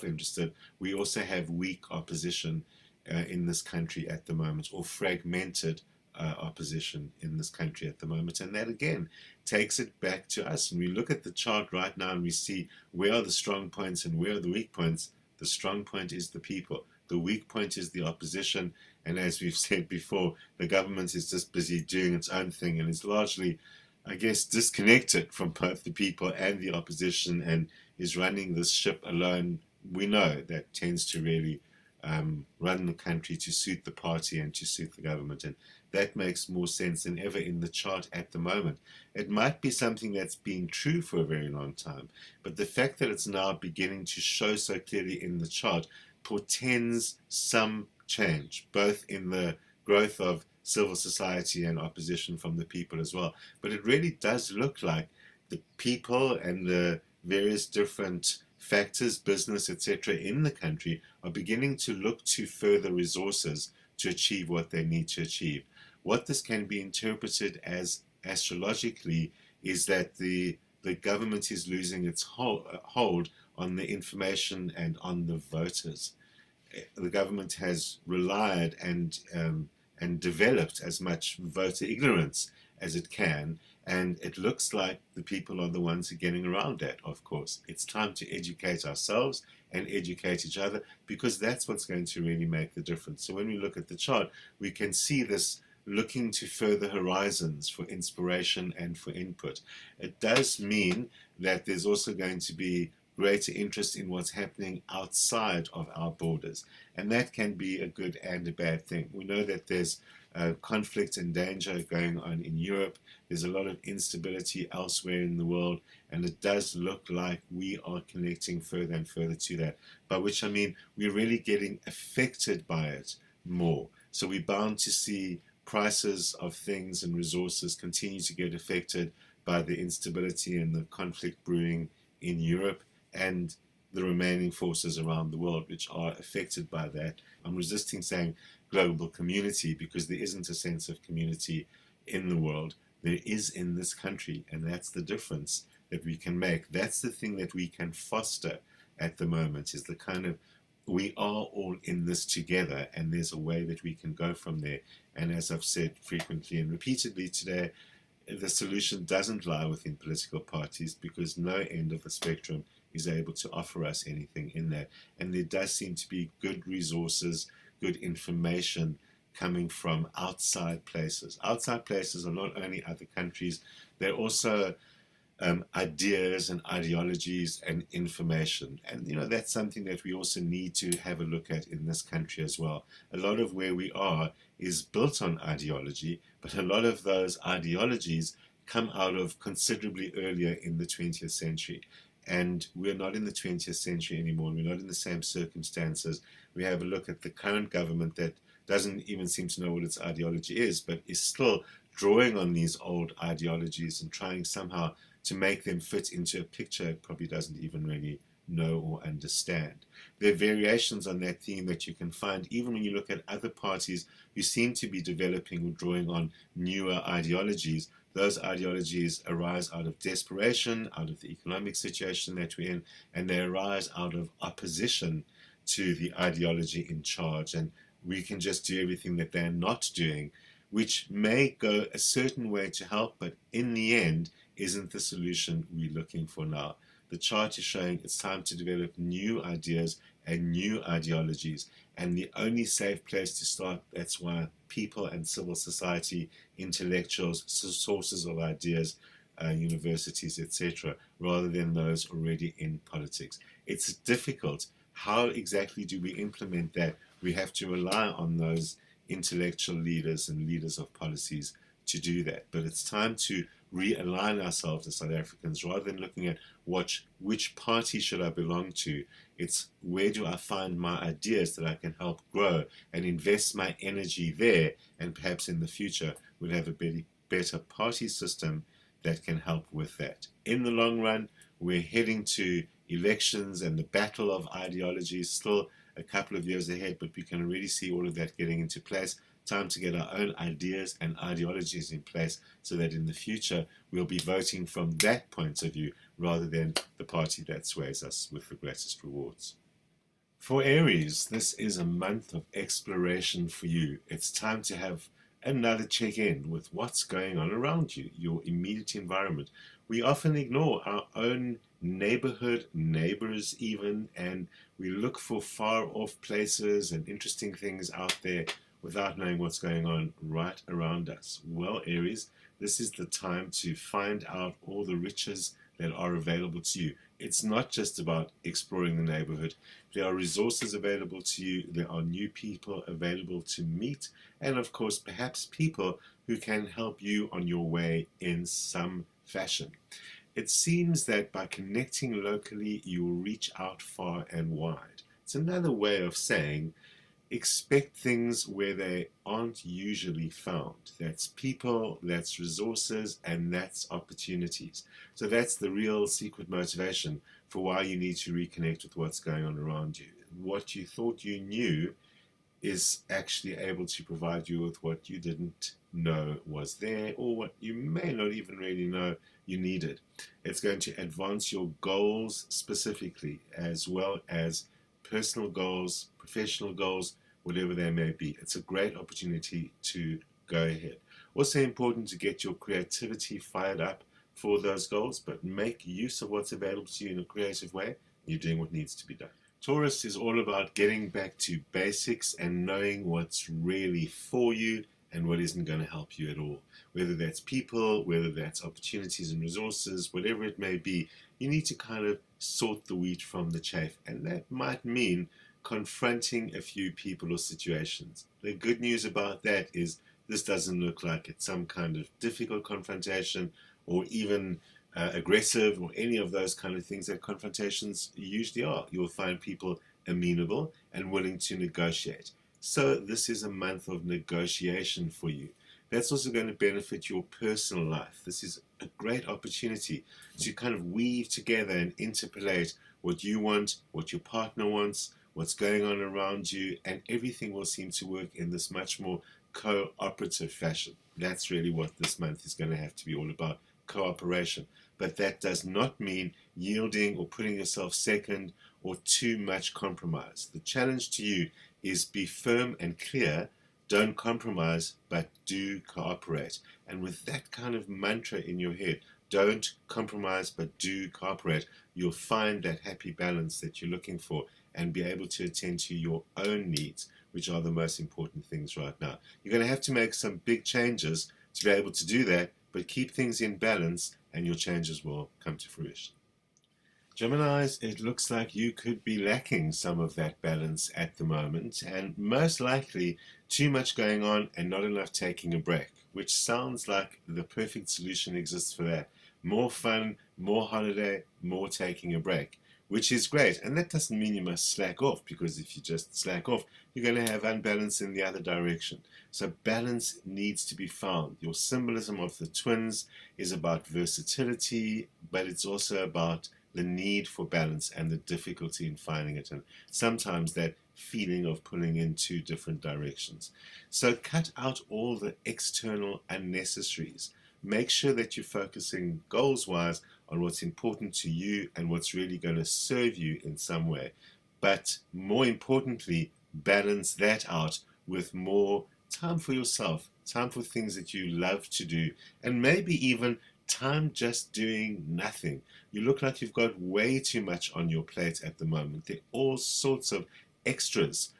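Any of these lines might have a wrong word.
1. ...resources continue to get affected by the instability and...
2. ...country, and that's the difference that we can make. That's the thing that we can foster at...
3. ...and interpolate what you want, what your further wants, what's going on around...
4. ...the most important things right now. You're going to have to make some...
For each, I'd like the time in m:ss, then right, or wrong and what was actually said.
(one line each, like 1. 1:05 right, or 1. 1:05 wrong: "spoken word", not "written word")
1. 2:07 right
2. 2:23 right
3. 7:11 wrong: "partner", not "further"
4. 7:47 right.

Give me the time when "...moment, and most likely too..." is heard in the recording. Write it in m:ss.
8:01.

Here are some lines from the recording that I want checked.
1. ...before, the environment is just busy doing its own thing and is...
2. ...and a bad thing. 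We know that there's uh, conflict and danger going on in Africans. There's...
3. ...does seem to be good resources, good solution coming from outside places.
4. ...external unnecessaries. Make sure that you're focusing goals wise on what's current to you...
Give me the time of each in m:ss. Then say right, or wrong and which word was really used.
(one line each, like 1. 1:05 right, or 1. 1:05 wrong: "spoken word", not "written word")
1. 0:19 wrong: "government", not "environment"
2. 1:48 wrong: "Europe", not "Africans"
3. 2:45 wrong: "information", not "solution"
4. 8:35 wrong: "important", not "current".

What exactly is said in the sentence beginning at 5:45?
It's another way of saying expect things where they aren't usually found.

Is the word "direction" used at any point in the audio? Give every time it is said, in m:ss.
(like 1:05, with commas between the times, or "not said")
8:18, 8:32.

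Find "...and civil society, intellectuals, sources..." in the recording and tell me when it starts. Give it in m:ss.
4:05.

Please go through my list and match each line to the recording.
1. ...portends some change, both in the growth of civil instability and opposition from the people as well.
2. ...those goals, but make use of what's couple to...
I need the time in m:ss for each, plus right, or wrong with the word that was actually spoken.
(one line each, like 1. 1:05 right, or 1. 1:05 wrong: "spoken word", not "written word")
1. 0:46 wrong: "society", not "instability"
2. 6:24 wrong: "available", not "couple".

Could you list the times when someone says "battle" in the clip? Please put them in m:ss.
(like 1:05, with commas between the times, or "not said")
4:43.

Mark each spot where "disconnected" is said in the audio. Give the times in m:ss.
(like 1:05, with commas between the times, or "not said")
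0:24.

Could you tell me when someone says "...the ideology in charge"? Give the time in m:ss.
3:45.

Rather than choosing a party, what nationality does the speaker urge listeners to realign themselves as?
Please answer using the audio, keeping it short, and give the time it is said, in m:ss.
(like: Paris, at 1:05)
South Africans, at 4:24.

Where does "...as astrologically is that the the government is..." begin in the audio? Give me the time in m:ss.
1:07.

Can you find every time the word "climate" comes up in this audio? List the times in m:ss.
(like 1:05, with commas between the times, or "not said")
not said.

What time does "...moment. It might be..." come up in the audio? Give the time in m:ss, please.
0:38.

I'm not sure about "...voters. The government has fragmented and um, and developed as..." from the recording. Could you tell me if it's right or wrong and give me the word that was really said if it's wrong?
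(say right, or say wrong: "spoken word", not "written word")
wrong: "relied", not "fragmented".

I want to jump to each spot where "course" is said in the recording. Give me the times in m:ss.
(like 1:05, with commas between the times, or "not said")
1:27, 5:34.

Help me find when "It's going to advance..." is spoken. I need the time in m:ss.
6:10.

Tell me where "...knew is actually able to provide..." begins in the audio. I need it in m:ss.
6:01.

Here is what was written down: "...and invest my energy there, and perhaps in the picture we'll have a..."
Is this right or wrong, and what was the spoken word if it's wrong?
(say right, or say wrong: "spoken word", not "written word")
wrong: "future", not "picture".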